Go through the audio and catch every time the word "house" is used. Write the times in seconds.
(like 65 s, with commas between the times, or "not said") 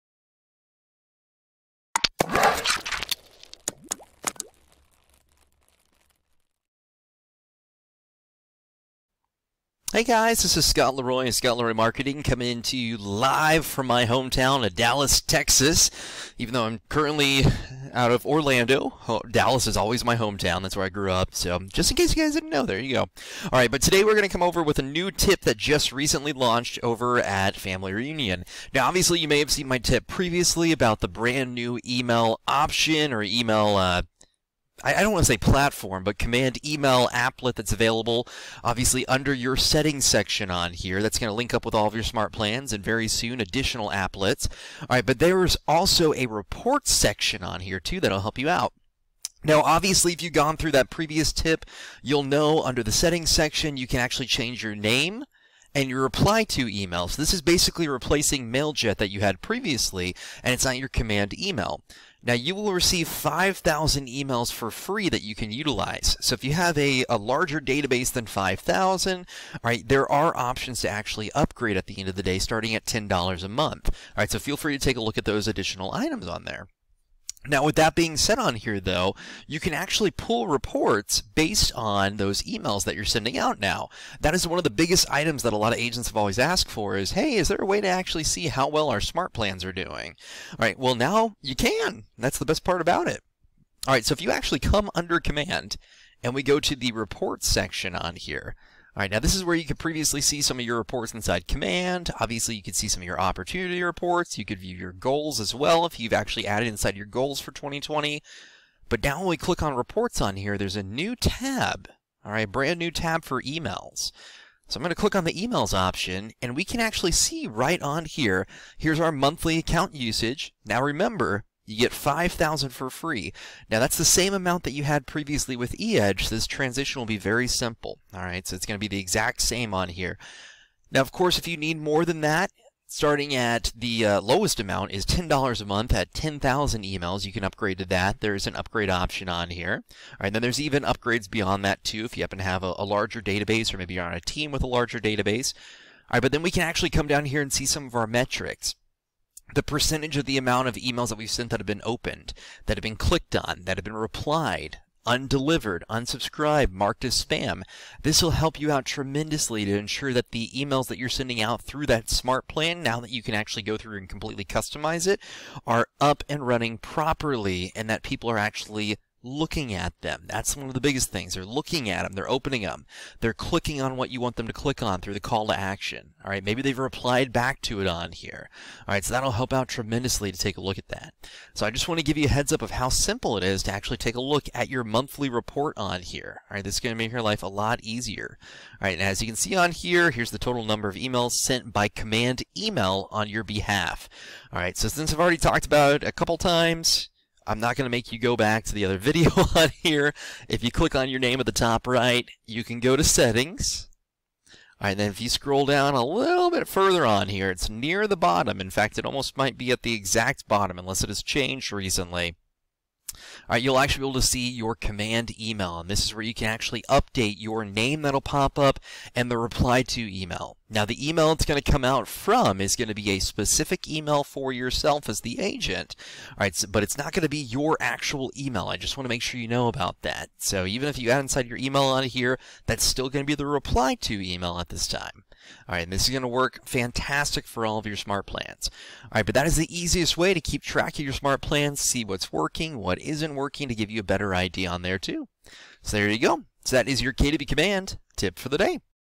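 not said.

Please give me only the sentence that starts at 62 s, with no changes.
Now you will receive 5,000 emails for free that you can utilize.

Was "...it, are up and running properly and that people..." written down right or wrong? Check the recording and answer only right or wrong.
right.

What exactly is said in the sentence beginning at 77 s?
Now, with that being said on here, though, you can actually pull reports based on those emails that you're sending out now.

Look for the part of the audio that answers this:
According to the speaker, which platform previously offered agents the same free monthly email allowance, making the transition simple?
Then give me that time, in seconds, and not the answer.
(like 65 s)
125 s.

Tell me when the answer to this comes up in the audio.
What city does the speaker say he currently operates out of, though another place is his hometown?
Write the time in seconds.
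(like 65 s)
18 s.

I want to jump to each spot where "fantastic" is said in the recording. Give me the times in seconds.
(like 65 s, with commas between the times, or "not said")
236 s.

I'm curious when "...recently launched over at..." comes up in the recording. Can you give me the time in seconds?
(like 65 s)
25 s.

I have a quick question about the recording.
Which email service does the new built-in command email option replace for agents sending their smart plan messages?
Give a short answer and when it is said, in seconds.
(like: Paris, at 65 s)
MailJet, at 58 s.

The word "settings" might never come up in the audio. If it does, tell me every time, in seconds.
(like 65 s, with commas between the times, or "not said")
39 s, 52 s, 203 s.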